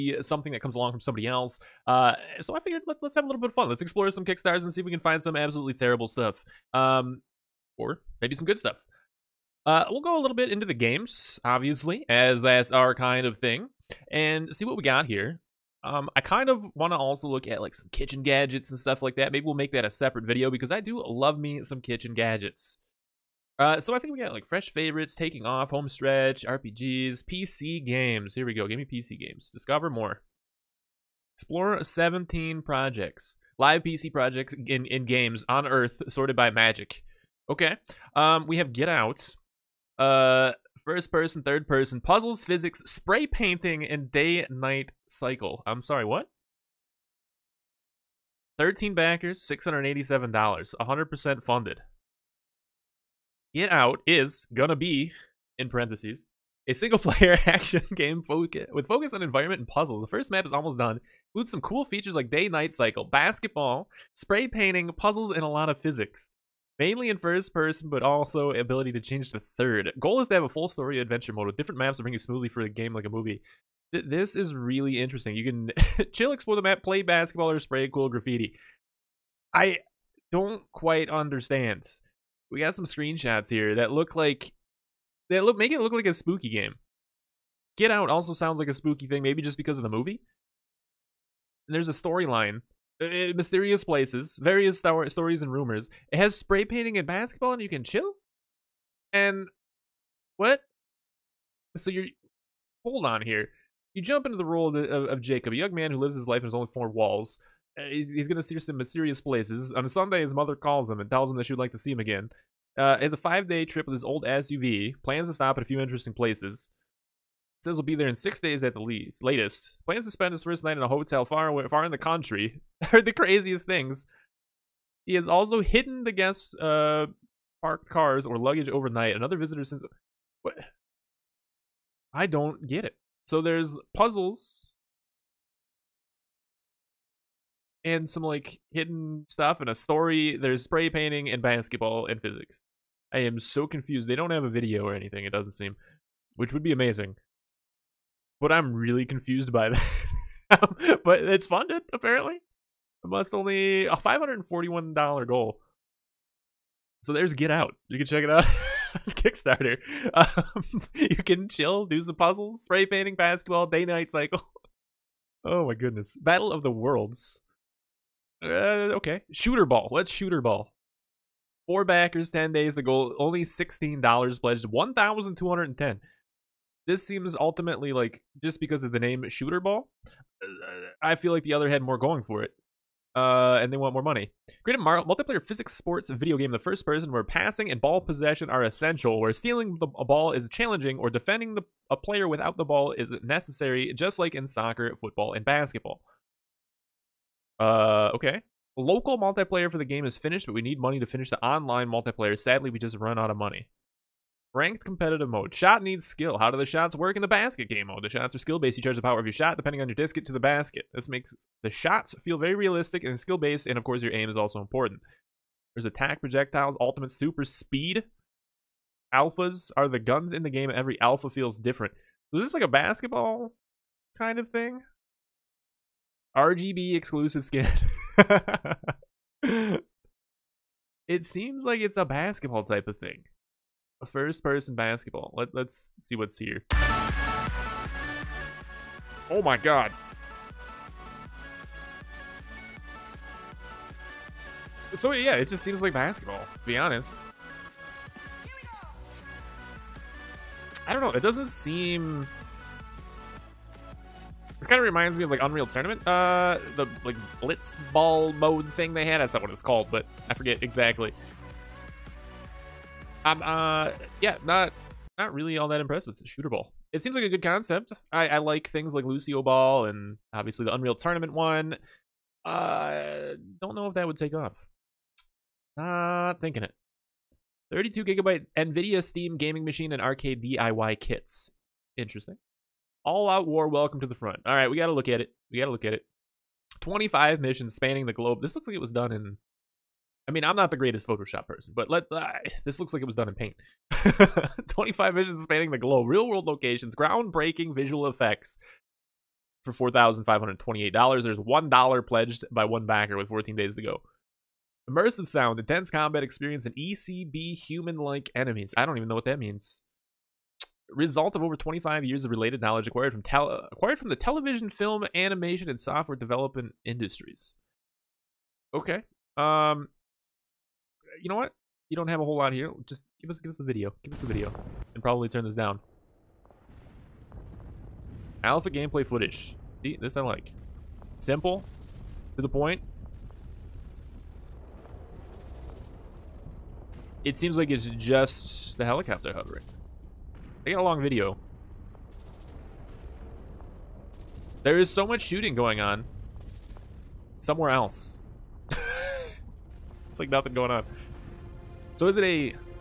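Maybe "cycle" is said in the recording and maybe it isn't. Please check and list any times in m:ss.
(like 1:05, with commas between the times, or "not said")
0:45, 1:02, 2:44.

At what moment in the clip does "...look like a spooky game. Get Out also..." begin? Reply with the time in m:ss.
1:25.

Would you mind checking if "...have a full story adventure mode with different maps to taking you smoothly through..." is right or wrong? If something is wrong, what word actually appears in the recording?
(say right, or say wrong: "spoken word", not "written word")
wrong: "bring", not "taking".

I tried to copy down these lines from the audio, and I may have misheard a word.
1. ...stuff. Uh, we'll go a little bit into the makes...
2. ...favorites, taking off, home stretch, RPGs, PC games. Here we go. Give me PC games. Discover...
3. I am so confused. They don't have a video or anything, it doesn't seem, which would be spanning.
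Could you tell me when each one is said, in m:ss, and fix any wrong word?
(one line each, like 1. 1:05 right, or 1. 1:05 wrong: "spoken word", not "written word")
1. 0:08 wrong: "games", not "makes"
2. 0:24 right
3. 2:23 wrong: "amazing", not "spanning".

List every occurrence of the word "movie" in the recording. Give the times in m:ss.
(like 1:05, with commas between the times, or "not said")
1:13, 1:29.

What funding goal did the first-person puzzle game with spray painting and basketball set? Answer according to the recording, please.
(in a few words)
$541.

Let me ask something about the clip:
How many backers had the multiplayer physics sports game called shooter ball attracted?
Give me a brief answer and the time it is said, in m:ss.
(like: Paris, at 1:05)
4, at 2:51.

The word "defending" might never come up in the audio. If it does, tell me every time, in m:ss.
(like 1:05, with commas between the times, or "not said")
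3:11.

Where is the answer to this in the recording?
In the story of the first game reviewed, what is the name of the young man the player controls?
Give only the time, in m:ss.
1:45.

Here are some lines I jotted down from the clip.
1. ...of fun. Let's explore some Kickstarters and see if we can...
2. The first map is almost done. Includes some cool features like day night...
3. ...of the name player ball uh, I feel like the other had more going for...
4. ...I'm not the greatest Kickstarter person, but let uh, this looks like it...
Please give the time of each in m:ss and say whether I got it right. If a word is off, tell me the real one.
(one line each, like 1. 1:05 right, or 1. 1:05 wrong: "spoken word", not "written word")
1. 0:03 right
2. 1:00 right
3. 2:58 wrong: "shooter", not "player"
4. 4:50 wrong: "Photoshop", not "Kickstarter".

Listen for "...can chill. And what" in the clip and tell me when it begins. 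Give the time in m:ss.
1:37.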